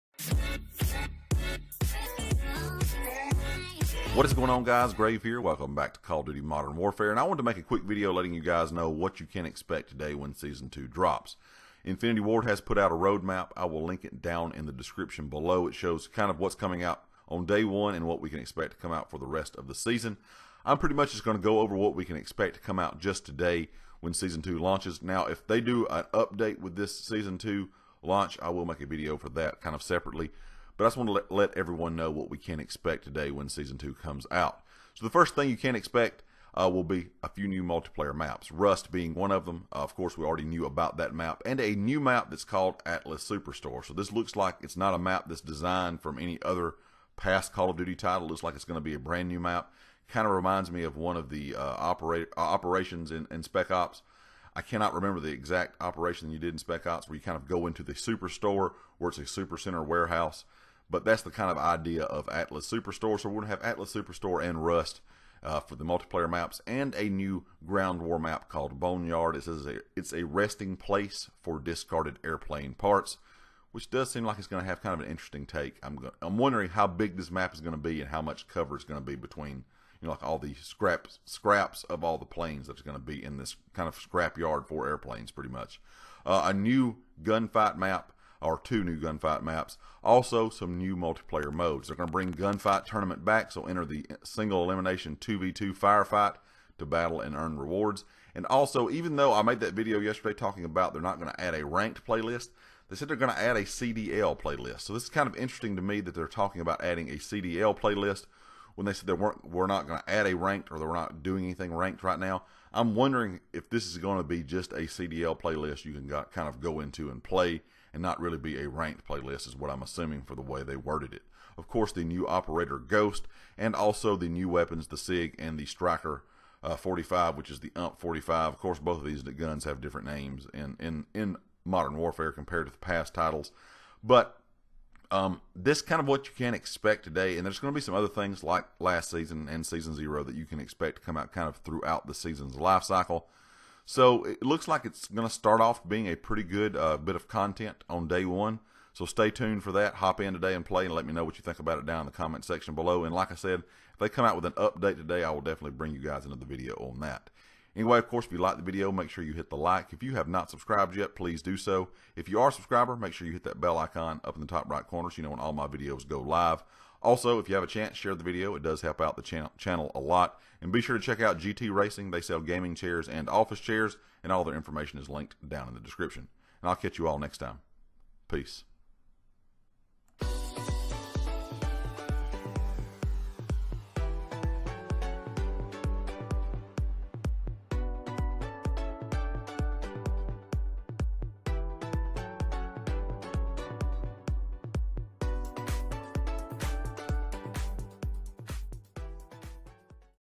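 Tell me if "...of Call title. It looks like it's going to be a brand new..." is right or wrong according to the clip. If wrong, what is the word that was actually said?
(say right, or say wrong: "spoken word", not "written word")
wrong: "Duty", not "Call".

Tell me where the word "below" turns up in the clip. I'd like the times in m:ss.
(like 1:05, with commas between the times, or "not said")
0:15, 2:32.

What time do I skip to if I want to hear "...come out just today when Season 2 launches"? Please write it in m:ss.
0:22.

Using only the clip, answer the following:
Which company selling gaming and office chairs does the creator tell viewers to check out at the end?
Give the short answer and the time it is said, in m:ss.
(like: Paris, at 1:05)
GT Racing, at 2:51.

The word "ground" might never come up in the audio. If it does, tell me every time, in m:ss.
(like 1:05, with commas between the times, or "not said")
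1:07.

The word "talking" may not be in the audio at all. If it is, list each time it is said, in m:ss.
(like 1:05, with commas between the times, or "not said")
1:40, 1:46.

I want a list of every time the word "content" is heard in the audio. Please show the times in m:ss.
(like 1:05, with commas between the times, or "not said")
2:27.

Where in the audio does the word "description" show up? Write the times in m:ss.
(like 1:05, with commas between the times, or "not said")
0:14, 2:55.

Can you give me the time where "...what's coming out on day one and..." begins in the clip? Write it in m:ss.
0:16.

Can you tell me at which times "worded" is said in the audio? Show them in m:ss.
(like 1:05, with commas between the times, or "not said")
2:00.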